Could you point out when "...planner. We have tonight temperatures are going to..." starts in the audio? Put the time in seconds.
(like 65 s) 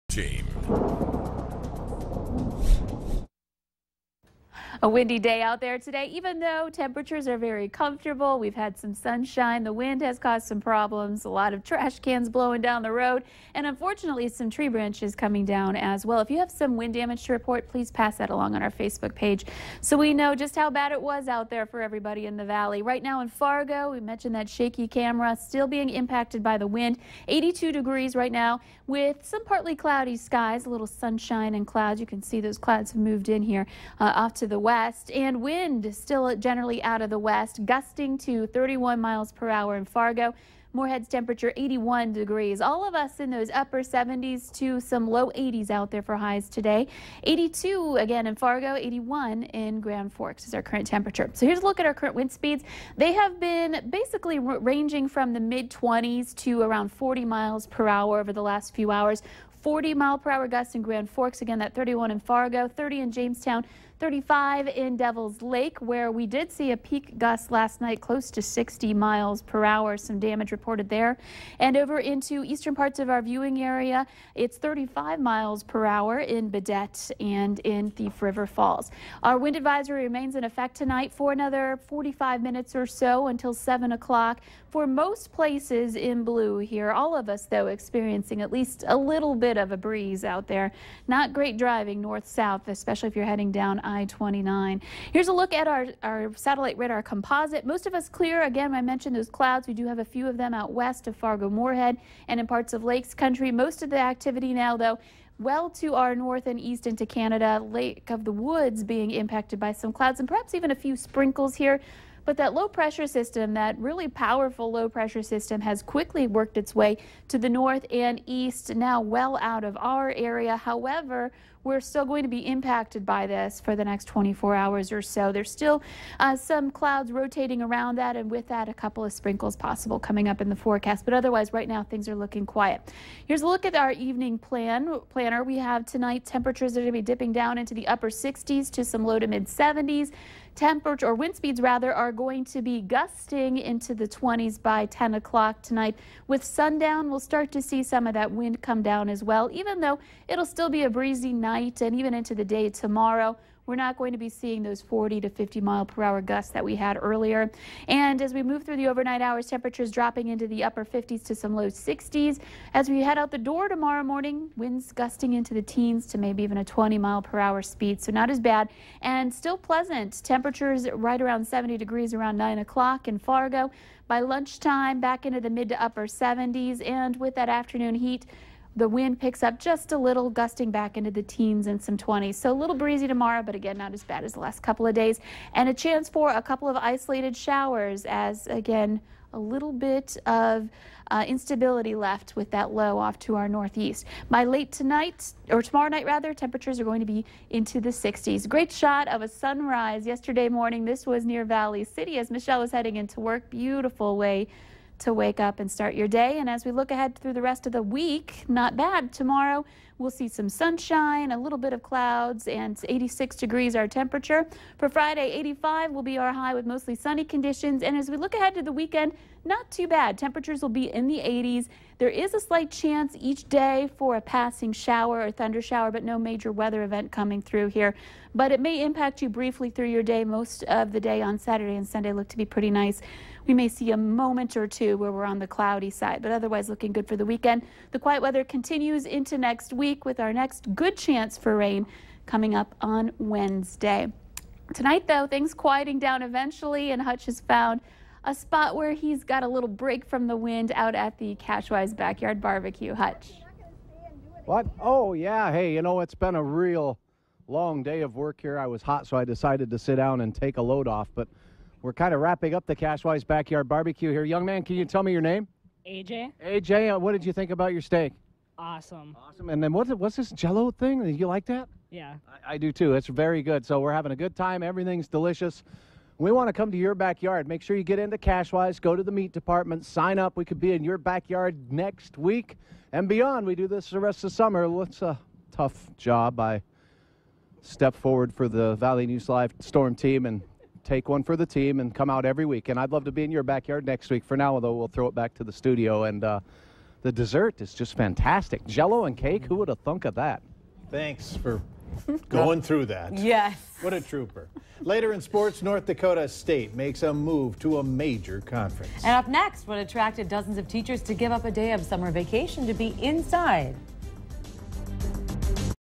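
135 s.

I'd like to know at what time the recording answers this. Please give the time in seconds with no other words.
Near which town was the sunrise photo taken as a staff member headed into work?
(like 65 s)
201 s.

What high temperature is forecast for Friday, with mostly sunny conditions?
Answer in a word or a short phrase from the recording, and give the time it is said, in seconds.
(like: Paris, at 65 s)
85, at 215 s.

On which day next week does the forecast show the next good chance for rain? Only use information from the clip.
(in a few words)
Wednesday.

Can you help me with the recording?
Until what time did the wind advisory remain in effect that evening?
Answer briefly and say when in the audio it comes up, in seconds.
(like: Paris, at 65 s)
7 o'clock, at 83 s.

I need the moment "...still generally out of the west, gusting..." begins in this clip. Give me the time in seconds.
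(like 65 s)
35 s.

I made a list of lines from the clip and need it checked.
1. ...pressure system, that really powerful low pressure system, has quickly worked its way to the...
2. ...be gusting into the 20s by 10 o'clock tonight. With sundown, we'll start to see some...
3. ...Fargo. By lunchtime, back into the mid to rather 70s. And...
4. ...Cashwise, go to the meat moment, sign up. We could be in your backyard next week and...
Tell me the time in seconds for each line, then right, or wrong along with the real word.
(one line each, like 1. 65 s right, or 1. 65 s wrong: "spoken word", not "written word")
1. 112 s right
2. 142 s right
3. 173 s wrong: "upper", not "rather"
4. 278 s wrong: "department", not "moment".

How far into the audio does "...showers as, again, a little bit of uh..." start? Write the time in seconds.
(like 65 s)
187 s.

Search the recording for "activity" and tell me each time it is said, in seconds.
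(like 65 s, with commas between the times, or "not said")
103 s.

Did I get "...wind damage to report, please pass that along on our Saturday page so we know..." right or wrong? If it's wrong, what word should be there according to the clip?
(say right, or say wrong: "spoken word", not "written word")
wrong: "Facebook", not "Saturday".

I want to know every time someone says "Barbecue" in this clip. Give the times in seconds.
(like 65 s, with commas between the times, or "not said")
252 s, 263 s.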